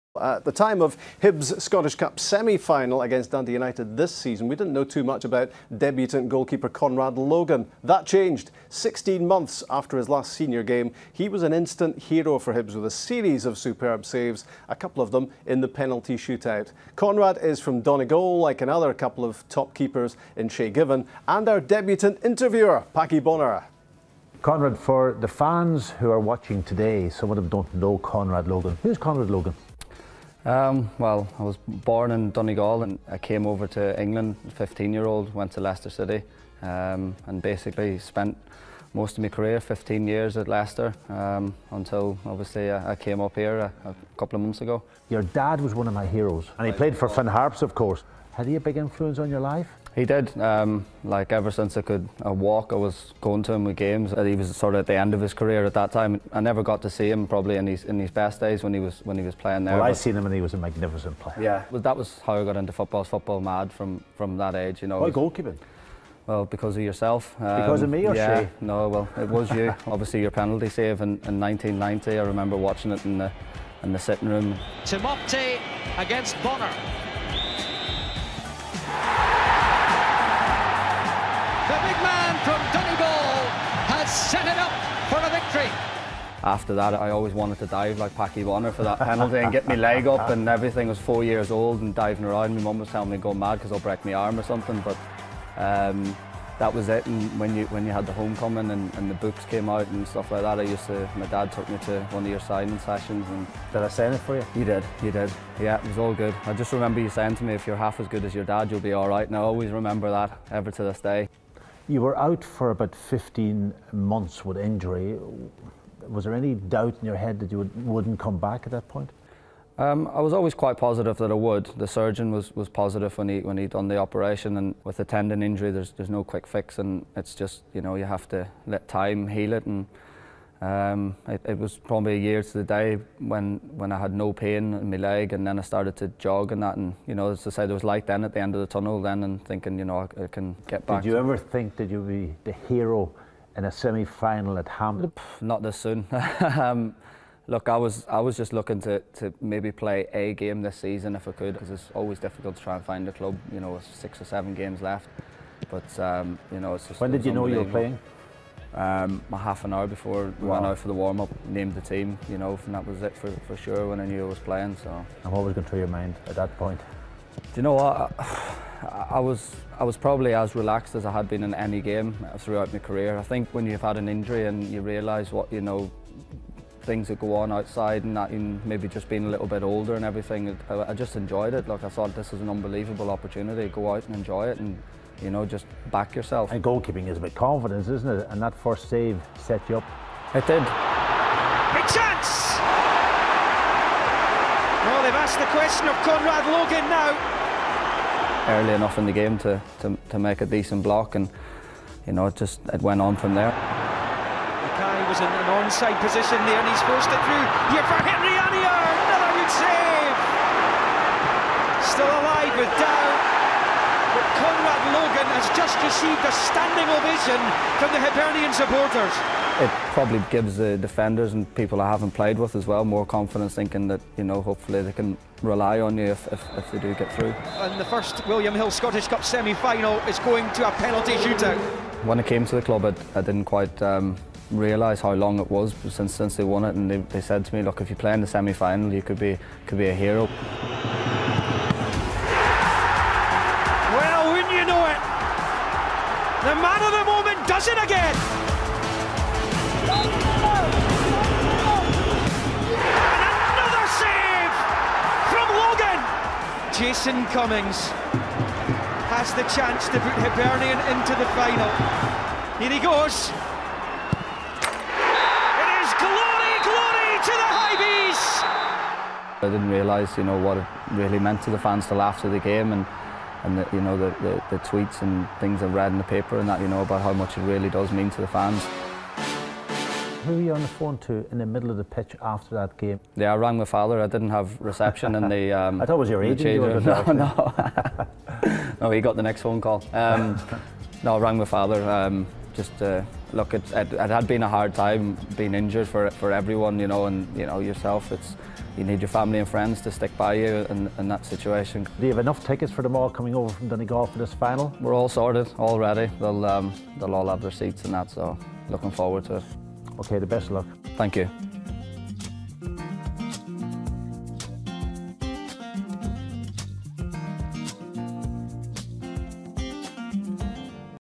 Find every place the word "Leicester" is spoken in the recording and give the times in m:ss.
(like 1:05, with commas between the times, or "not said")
0:35, 0:40.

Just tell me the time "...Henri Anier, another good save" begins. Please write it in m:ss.
3:28.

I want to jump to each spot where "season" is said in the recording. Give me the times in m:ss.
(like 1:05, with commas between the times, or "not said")
0:04, 2:30.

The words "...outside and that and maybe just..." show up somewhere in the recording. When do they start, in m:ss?
2:57.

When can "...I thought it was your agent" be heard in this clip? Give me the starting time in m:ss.
4:45.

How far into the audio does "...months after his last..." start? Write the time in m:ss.
0:09.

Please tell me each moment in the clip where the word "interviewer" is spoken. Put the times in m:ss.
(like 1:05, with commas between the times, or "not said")
0:22.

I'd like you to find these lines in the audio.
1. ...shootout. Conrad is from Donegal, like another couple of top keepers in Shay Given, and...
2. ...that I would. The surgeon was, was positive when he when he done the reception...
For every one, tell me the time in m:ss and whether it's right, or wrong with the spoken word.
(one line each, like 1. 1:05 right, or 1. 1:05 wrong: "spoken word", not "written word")
1. 0:16 right
2. 2:01 wrong: "operation", not "reception".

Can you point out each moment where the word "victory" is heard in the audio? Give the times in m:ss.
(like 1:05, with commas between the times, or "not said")
1:25.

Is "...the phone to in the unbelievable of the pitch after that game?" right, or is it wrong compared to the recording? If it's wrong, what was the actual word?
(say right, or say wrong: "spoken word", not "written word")
wrong: "middle", not "unbelievable".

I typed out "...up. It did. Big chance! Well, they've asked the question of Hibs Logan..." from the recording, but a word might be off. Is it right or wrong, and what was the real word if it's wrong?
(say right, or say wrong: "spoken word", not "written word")
wrong: "Conrad", not "Hibs".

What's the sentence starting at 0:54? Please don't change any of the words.
He was sort of at the end of his career at that time.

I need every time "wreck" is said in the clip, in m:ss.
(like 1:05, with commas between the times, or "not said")
not said.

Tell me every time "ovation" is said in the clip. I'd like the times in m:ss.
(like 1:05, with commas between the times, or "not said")
3:36.